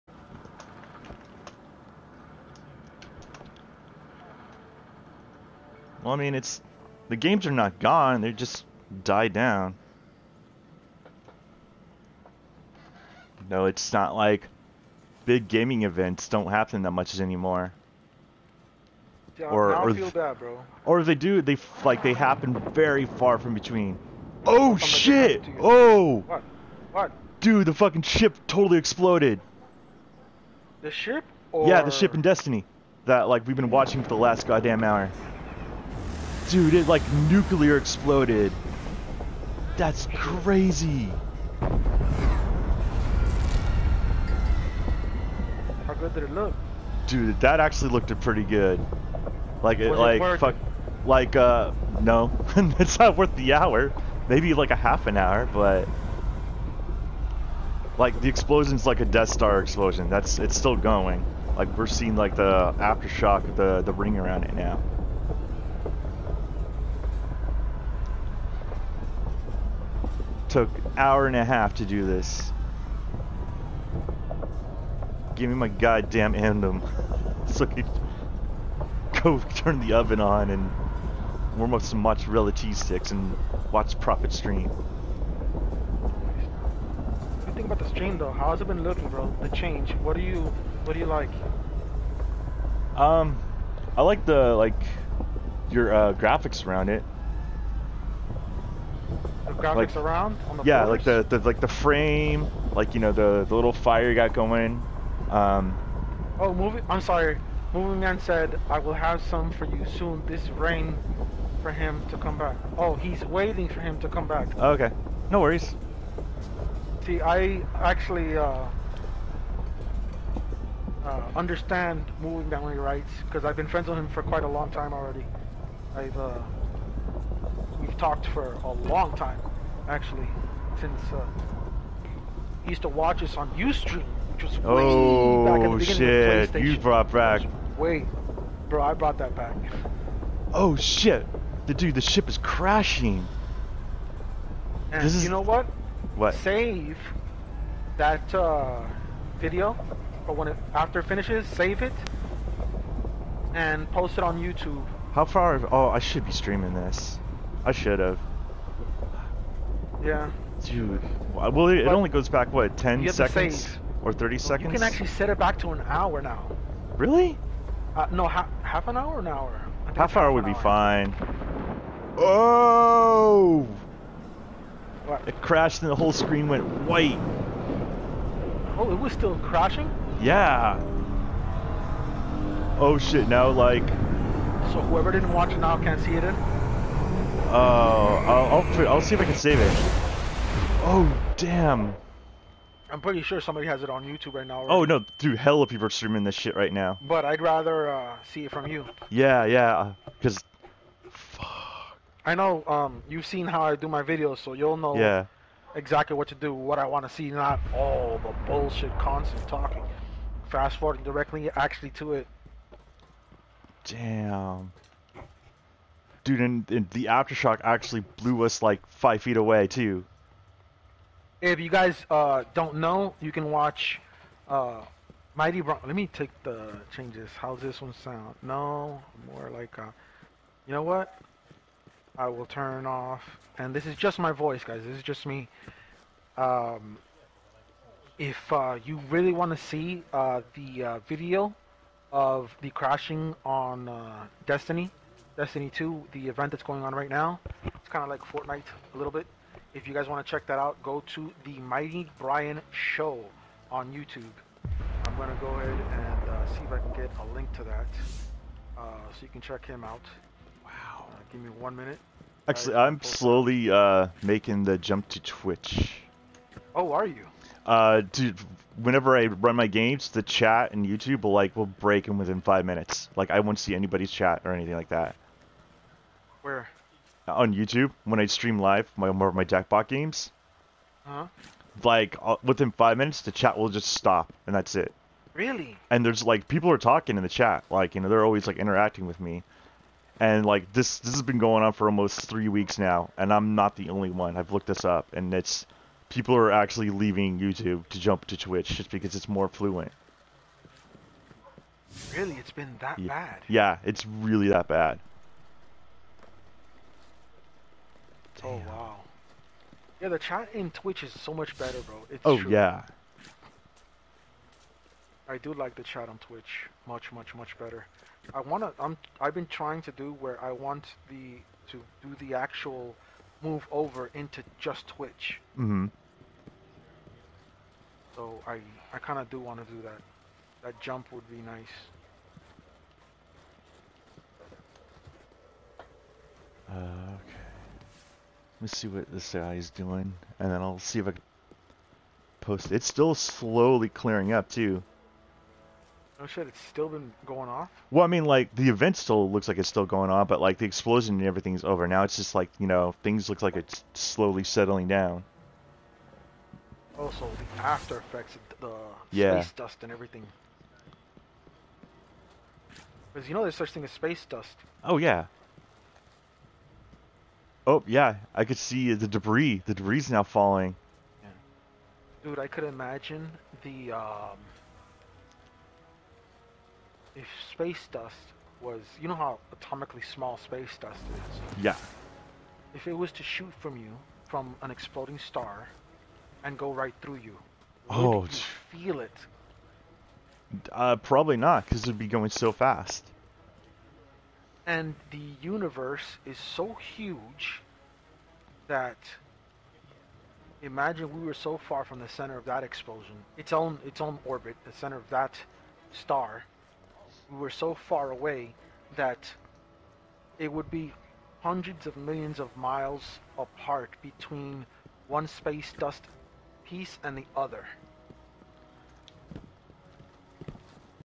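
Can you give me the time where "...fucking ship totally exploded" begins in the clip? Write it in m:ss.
0:27.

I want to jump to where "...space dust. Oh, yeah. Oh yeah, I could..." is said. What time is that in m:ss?
6:03.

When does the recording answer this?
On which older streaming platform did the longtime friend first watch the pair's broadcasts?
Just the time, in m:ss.
2:13.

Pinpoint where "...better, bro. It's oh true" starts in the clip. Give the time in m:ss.
5:11.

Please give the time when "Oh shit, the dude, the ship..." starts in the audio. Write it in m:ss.
2:20.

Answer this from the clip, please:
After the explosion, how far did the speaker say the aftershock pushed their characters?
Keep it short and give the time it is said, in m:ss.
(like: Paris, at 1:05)
five feet, at 3:38.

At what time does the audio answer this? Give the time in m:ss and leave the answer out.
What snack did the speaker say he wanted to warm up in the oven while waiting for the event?
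1:21.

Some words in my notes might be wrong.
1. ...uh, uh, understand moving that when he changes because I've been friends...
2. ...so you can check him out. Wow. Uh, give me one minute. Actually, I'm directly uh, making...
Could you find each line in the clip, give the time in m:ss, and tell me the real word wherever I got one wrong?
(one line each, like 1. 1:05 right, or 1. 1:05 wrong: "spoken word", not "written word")
1. 1:58 wrong: "writes", not "changes"
2. 4:19 wrong: "slowly", not "directly".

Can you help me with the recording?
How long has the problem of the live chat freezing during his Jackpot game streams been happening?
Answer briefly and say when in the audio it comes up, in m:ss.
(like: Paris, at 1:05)
almost three weeks, at 4:51.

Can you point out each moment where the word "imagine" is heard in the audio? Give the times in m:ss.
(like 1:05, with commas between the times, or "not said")
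6:12, 6:40.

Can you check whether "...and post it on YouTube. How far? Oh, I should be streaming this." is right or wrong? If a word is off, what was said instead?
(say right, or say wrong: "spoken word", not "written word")
right.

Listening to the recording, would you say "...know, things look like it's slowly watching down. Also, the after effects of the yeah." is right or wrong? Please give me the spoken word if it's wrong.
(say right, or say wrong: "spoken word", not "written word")
wrong: "settling", not "watching".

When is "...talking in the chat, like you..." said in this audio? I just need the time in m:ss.
4:46.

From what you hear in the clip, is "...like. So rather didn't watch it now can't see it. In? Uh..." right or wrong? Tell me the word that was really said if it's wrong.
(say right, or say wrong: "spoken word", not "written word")
wrong: "whoever", not "rather".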